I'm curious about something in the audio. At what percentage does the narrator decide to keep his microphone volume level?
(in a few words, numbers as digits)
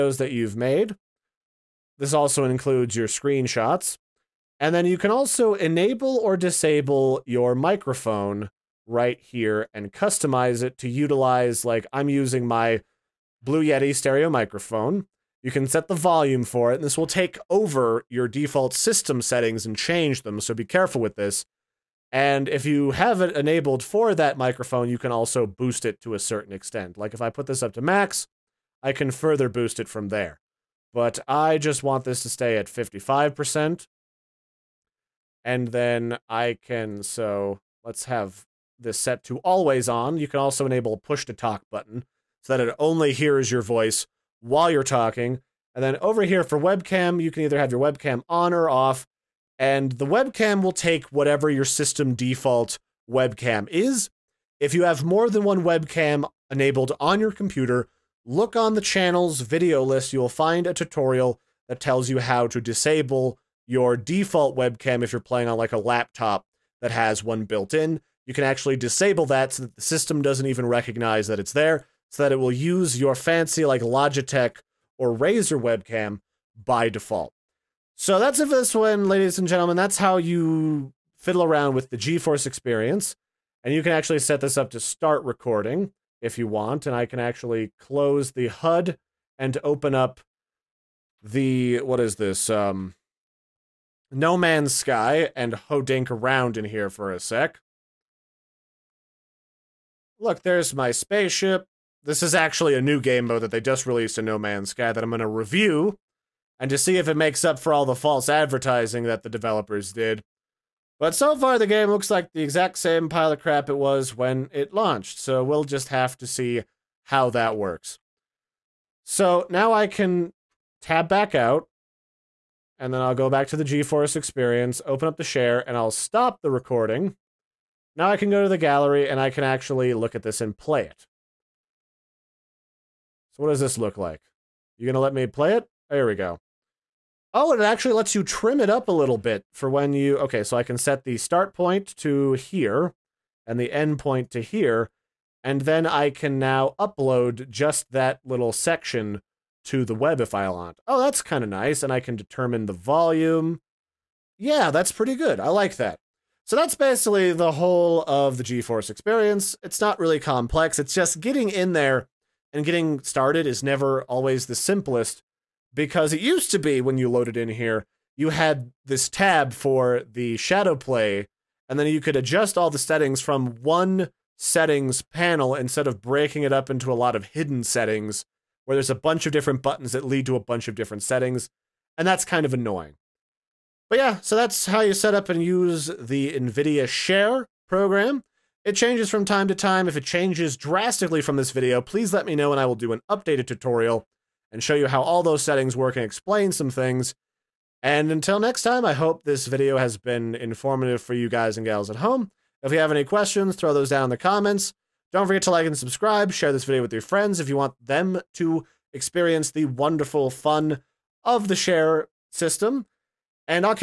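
55%.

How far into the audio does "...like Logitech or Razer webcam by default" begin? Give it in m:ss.
1:13.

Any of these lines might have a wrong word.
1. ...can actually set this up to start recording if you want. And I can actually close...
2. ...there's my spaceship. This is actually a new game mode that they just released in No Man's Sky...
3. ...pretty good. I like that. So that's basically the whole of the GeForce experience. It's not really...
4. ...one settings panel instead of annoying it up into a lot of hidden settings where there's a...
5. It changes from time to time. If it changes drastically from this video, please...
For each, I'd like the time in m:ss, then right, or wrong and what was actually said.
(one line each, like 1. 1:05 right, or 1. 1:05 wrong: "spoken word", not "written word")
1. 1:23 right
2. 1:40 right
3. 2:34 right
4. 2:53 wrong: "breaking", not "annoying"
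5. 3:08 right.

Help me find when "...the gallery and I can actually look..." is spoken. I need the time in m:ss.
2:08.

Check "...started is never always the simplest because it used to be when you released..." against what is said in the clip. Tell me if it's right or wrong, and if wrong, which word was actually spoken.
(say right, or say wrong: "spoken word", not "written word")
wrong: "loaded", not "released".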